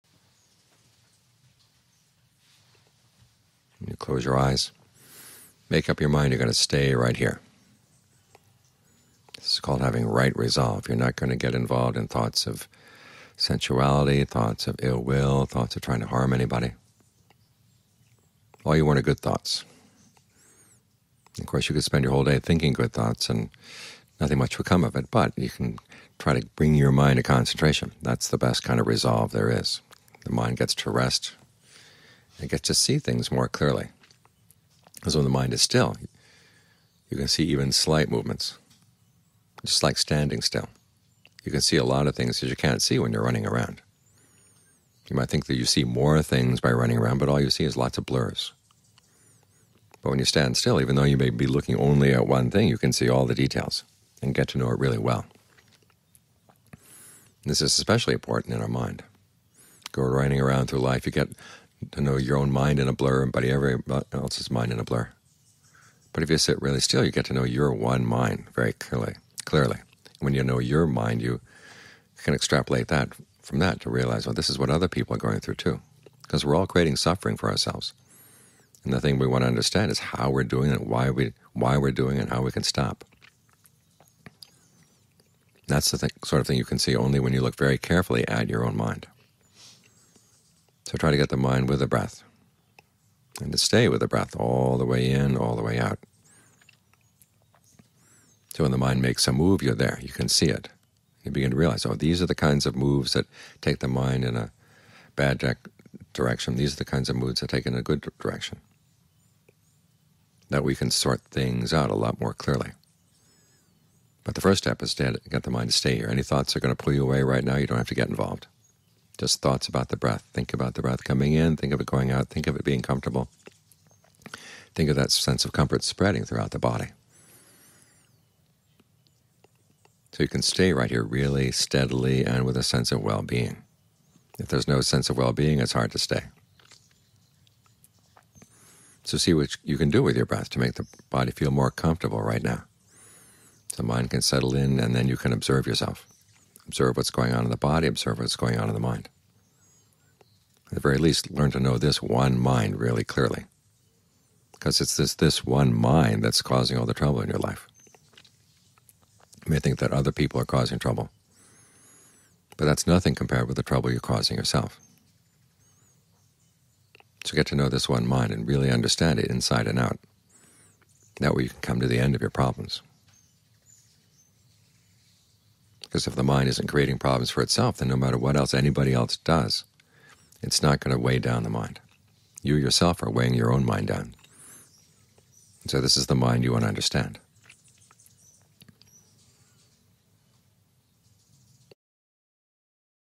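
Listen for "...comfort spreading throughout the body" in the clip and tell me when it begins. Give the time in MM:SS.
02:05.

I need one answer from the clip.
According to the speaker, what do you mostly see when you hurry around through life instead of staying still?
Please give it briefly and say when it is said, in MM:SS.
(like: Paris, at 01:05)
lots of blurs, at 00:47.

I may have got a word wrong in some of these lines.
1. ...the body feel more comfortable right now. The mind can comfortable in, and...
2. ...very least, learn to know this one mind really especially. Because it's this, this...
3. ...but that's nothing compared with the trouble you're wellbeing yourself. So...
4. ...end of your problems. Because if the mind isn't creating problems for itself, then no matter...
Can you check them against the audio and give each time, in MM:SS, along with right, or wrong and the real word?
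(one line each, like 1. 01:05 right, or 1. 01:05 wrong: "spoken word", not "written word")
1. 02:20 wrong: "settle", not "comfortable"
2. 02:30 wrong: "clearly", not "especially"
3. 02:42 wrong: "causing", not "wellbeing"
4. 02:51 right.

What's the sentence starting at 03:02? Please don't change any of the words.
You yourself are weighing your own mind down.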